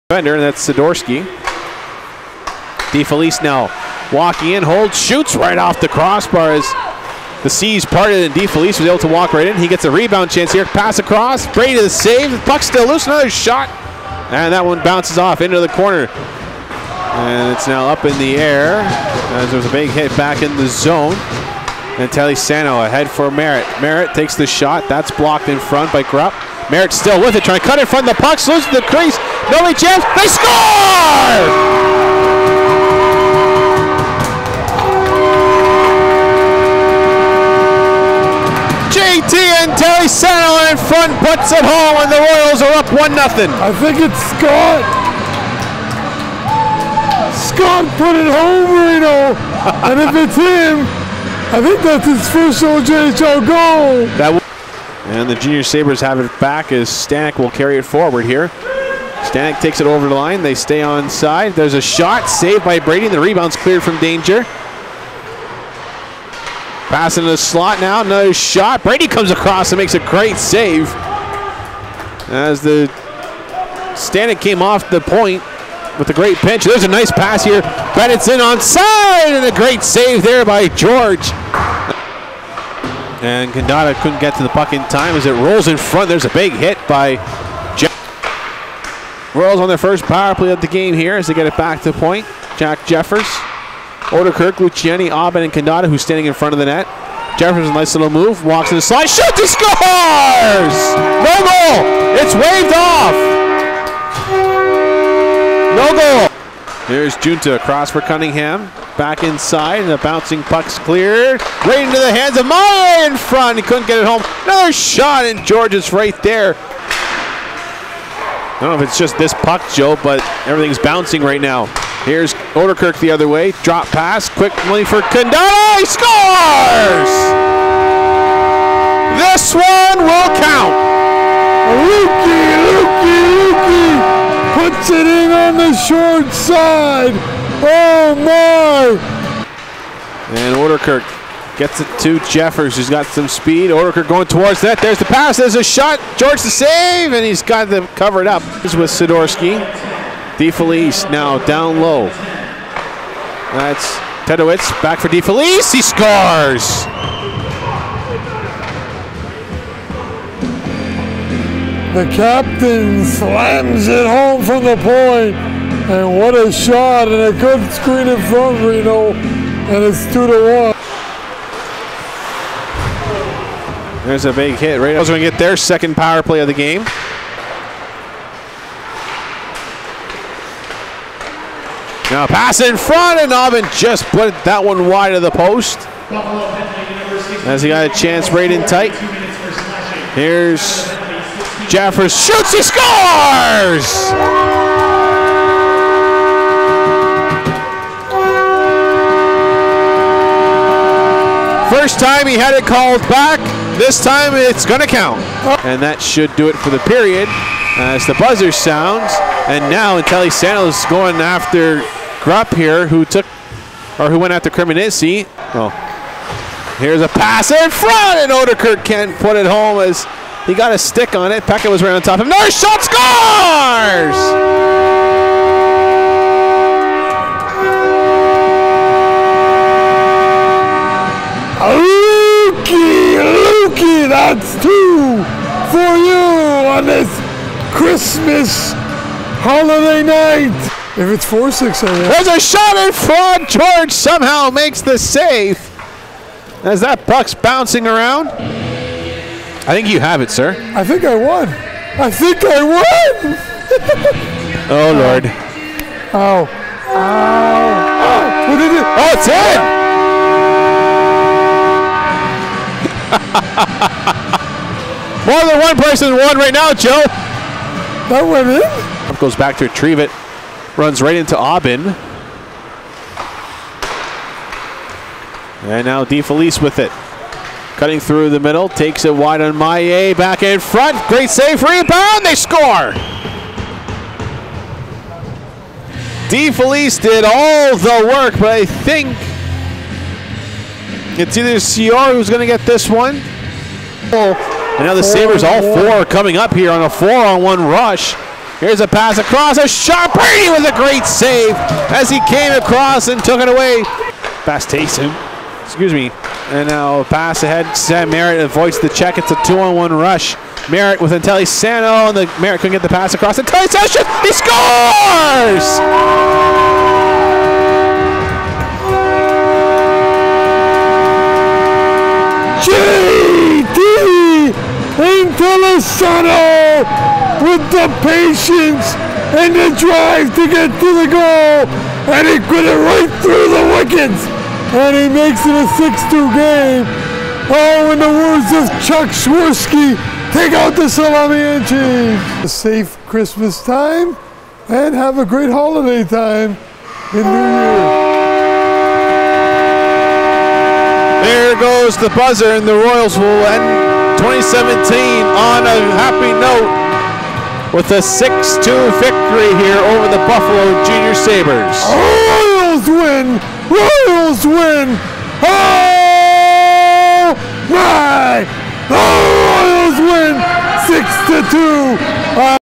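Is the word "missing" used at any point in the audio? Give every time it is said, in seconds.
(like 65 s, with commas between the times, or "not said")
not said.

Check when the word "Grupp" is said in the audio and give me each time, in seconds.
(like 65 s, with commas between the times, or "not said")
26 s, 212 s.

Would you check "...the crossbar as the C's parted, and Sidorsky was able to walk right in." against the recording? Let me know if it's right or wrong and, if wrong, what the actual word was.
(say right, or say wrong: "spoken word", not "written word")
wrong: "DeFelice", not "Sidorsky".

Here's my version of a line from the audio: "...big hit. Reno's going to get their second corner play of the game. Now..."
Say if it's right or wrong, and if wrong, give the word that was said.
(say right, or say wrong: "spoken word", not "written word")
wrong: "power", not "corner".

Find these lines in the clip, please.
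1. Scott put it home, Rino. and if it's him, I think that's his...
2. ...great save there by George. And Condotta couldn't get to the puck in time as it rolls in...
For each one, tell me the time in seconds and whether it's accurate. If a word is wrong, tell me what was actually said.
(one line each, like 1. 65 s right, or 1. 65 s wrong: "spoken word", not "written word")
1. 47 s right
2. 79 s right.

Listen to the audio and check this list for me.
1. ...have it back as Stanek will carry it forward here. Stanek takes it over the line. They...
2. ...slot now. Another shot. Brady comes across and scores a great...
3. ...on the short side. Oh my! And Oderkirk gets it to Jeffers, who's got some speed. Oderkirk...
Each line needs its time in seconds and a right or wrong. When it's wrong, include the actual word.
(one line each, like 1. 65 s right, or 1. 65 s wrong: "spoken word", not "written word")
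1. 55 s right
2. 67 s wrong: "makes", not "scores"
3. 135 s right.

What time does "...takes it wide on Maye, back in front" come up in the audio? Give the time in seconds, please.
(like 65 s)
278 s.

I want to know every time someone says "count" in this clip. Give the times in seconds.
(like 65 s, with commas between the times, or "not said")
204 s.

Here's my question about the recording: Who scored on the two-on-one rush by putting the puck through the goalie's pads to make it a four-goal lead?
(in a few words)
JD Intellisano.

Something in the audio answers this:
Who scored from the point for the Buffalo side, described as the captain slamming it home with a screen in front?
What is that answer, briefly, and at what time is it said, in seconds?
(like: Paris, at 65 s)
Tedowitz, at 154 s.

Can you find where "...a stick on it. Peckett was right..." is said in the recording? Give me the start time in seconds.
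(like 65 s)
220 s.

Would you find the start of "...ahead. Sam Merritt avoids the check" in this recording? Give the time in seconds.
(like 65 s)
307 s.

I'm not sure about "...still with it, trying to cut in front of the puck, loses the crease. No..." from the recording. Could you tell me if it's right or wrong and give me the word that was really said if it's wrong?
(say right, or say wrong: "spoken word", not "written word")
right.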